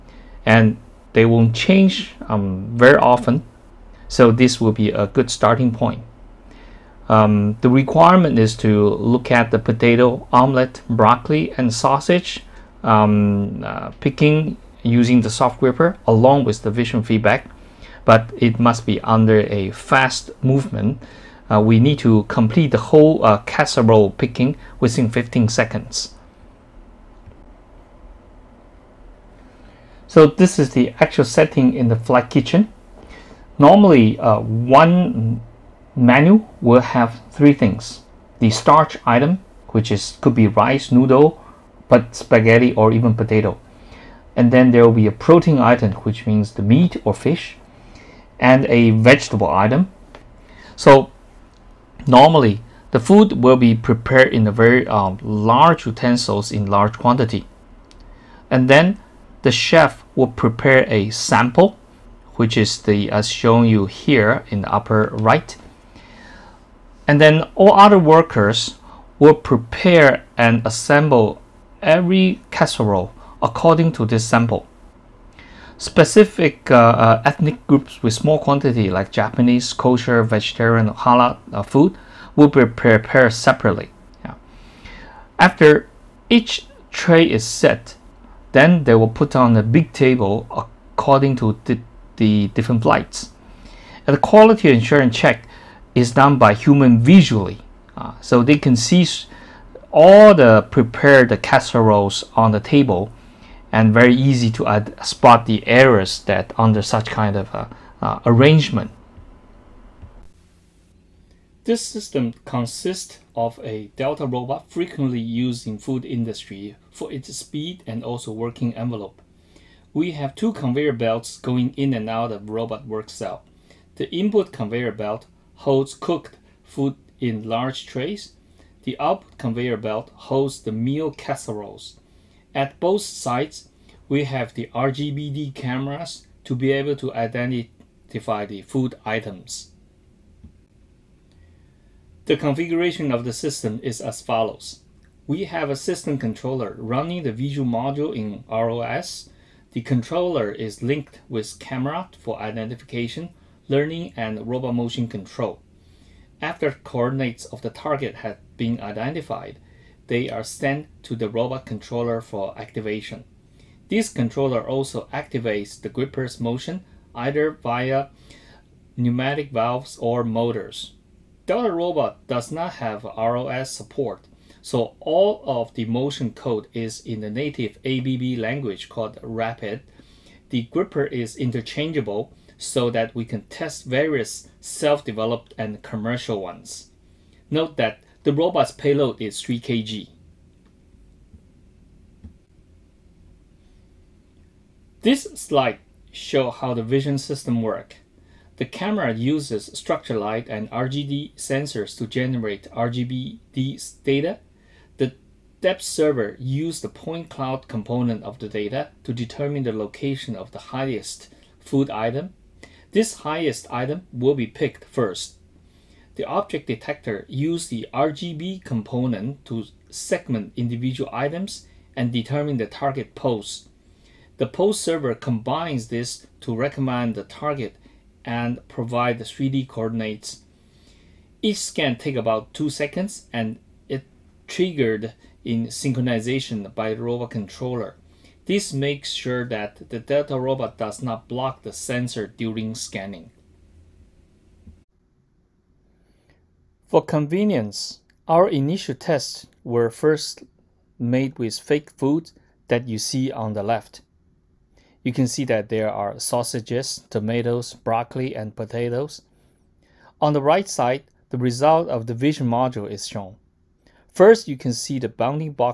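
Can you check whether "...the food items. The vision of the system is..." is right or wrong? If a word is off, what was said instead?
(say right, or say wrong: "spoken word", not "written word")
wrong: "configuration", not "vision".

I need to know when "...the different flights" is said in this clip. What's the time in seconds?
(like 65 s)
92 s.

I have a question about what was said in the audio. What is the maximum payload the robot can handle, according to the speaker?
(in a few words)
3 kg.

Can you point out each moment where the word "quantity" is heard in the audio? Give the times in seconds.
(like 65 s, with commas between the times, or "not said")
56 s, 78 s.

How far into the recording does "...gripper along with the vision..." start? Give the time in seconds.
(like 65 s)
15 s.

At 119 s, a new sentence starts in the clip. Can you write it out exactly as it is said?
We have two conveyor belts going in and out of robot work cell.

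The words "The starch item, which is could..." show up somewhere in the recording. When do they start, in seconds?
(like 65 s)
38 s.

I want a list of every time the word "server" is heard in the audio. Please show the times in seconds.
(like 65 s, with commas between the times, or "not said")
205 s, 224 s.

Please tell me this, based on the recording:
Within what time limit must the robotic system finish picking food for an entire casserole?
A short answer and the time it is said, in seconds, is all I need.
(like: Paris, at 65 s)
15 seconds, at 25 s.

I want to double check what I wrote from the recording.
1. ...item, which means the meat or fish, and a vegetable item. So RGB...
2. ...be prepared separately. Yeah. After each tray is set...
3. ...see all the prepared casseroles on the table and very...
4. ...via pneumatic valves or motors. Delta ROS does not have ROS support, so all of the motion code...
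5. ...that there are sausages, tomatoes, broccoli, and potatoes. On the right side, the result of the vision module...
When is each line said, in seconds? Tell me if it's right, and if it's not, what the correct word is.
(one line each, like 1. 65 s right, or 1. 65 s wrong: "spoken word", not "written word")
1. 45 s wrong: "Normally", not "RGB"
2. 82 s right
3. 98 s right
4. 167 s wrong: "Robot", not "ROS"
5. 255 s right.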